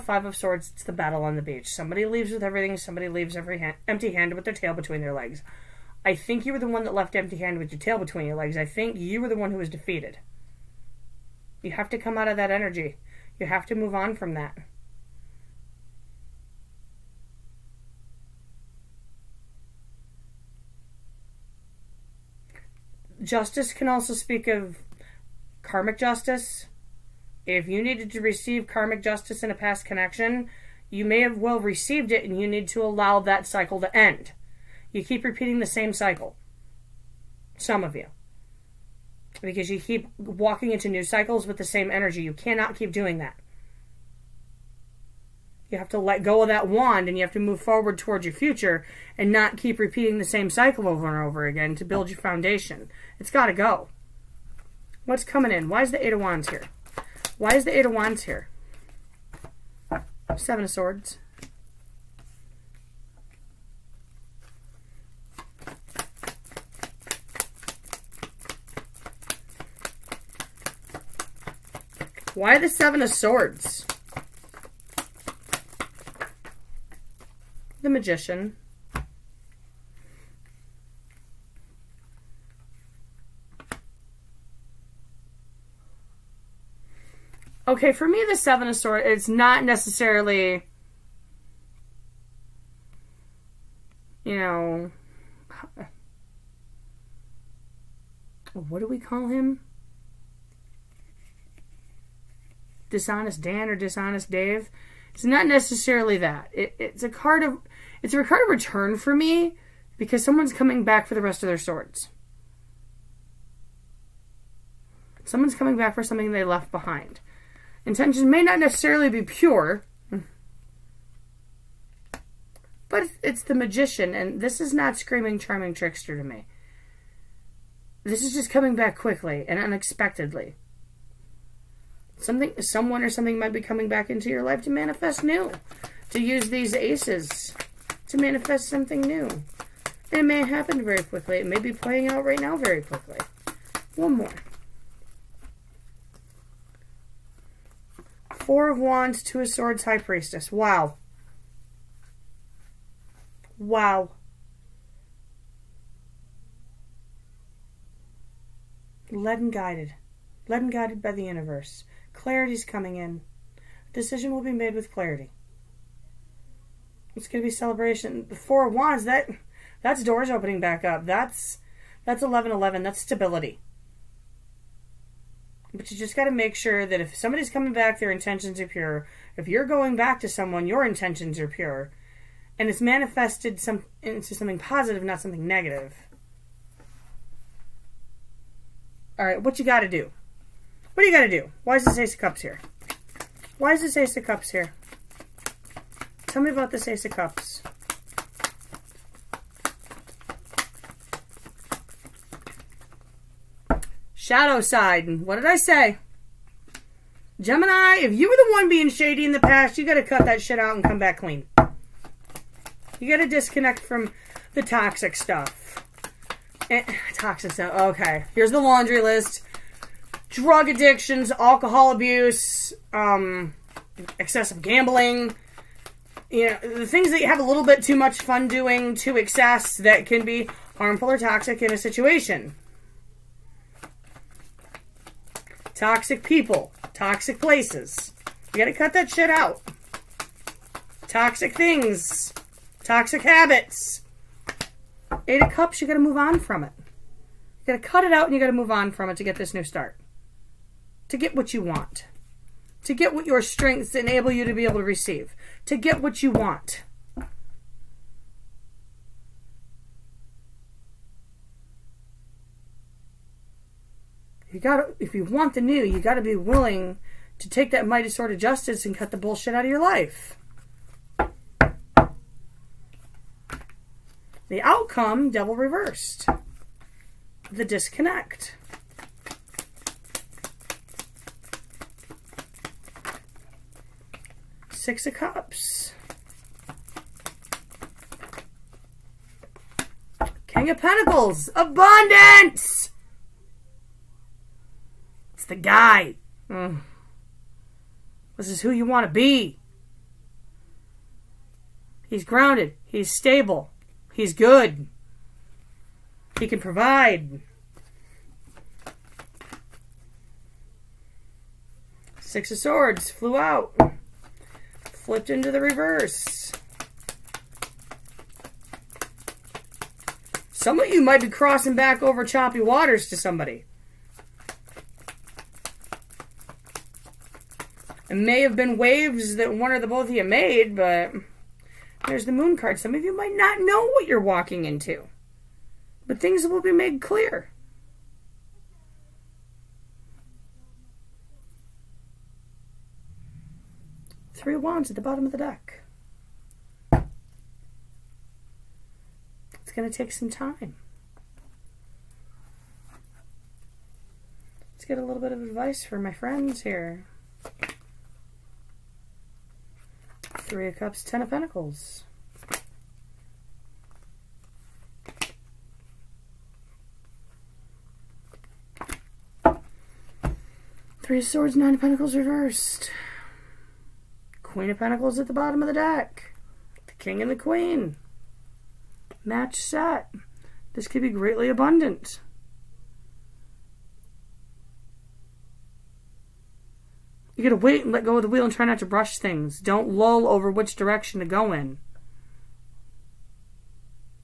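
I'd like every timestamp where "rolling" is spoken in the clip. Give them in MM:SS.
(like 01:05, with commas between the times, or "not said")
not said.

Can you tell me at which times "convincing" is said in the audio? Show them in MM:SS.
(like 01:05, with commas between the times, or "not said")
not said.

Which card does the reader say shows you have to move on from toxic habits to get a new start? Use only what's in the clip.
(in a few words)
Eight of Cups.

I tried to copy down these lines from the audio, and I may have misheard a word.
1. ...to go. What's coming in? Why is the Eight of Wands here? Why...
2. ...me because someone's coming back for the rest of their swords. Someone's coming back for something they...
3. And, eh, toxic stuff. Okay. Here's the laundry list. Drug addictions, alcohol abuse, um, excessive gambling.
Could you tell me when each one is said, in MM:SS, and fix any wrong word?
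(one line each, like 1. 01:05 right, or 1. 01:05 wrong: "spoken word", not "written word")
1. 00:53 right
2. 01:49 right
3. 03:36 right.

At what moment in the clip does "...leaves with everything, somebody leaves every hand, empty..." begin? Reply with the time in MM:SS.
00:02.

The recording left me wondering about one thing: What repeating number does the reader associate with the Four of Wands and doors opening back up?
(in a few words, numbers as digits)
1111.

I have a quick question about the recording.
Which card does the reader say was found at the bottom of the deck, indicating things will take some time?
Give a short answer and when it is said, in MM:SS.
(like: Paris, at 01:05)
Three of Wands, at 05:44.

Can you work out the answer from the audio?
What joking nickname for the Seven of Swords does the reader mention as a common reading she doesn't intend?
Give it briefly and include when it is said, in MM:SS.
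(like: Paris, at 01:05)
Dishonest Dan, at 01:42.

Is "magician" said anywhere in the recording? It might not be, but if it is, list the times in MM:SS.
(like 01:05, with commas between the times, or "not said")
01:17, 02:03.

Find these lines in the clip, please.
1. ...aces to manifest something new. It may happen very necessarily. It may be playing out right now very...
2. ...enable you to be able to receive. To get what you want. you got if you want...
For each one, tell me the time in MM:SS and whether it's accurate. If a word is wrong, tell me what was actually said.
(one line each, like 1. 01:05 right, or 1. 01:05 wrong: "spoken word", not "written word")
1. 02:16 wrong: "quickly", not "necessarily"
2. 04:13 right.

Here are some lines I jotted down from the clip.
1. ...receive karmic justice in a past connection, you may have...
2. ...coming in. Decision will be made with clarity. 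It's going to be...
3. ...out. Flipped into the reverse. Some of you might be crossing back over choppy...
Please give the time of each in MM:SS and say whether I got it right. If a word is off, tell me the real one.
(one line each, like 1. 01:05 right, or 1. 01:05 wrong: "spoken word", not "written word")
1. 00:28 right
2. 02:42 right
3. 05:13 right.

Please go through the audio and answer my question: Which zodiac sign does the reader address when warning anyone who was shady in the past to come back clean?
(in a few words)
Gemini.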